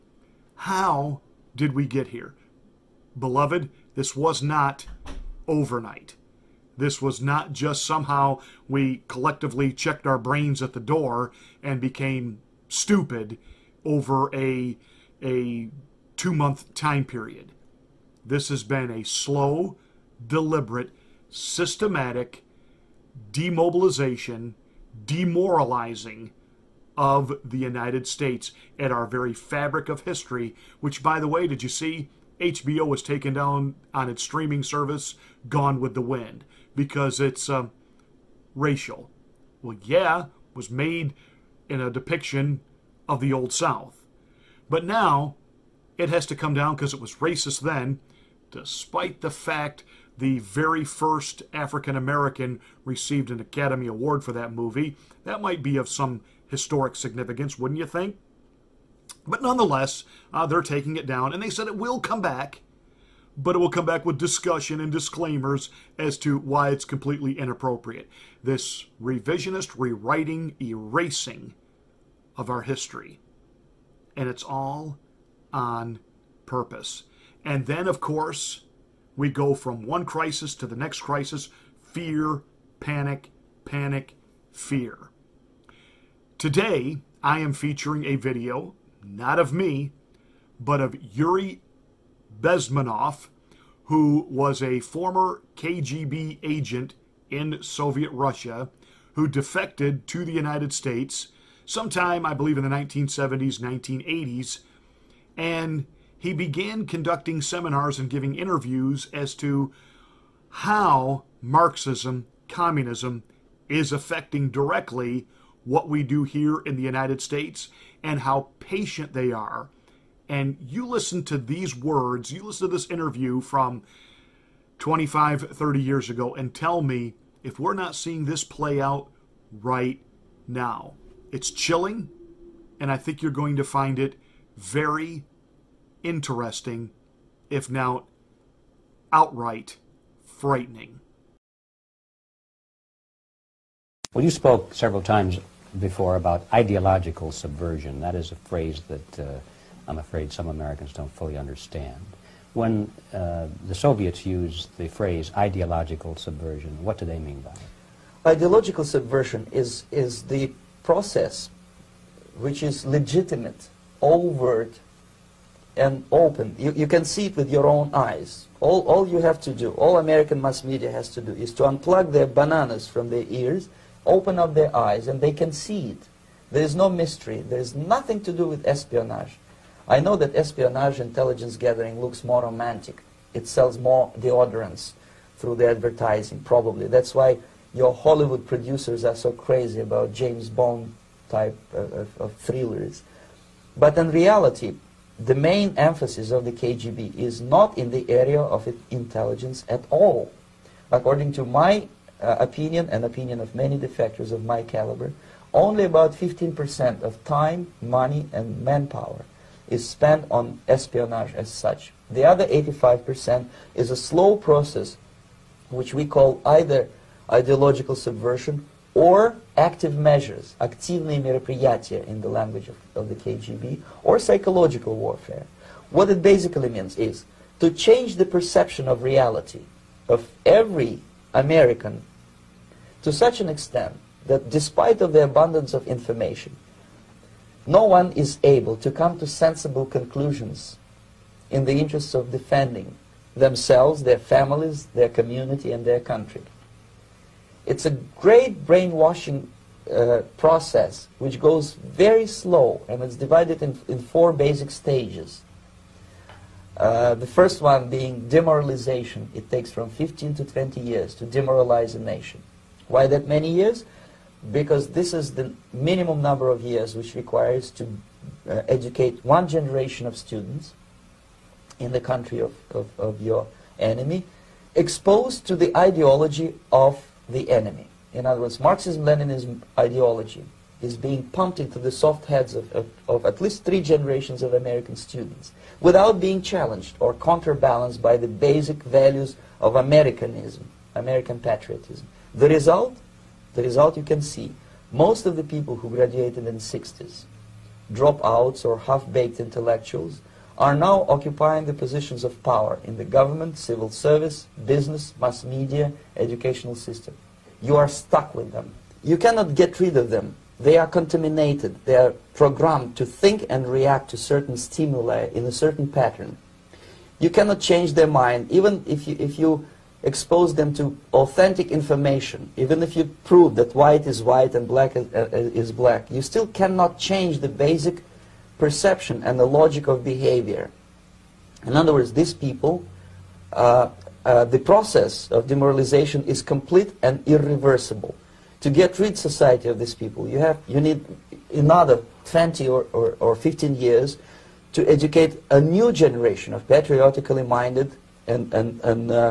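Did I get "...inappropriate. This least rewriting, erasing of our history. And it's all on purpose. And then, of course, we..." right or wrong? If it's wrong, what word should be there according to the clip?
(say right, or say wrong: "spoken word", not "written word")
wrong: "revisionist", not "least".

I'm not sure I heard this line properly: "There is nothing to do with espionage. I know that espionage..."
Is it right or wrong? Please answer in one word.
right.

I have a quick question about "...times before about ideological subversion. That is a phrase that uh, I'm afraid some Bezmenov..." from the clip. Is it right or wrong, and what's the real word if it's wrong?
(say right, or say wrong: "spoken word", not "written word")
wrong: "Americans", not "Bezmenov".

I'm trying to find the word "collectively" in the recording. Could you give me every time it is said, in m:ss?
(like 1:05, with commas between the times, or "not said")
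0:09.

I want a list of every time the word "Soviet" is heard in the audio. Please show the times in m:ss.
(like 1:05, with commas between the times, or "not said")
1:37, 2:33.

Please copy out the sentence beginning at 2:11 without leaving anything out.
It's chilling, and I think you're going to find it very, interesting, if not outright frightening.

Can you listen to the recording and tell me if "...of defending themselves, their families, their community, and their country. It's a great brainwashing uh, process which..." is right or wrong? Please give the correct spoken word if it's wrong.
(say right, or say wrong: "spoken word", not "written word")
right.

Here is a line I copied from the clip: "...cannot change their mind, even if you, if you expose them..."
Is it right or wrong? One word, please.
right.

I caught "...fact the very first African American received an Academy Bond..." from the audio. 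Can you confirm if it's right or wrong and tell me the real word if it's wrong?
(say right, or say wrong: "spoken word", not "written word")
wrong: "Award", not "Bond".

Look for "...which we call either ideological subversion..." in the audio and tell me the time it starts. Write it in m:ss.
3:35.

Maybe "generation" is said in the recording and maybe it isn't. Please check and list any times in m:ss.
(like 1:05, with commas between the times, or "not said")
4:29, 4:43, 5:45.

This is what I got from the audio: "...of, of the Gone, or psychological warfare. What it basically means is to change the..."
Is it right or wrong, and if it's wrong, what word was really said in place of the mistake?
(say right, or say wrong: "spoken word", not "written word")
wrong: "KGB", not "Gone".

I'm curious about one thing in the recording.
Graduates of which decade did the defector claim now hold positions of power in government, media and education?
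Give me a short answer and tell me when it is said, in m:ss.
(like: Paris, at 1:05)
the 60s, at 4:56.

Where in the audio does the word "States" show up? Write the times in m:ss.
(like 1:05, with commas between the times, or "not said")
0:28, 1:40, 1:57.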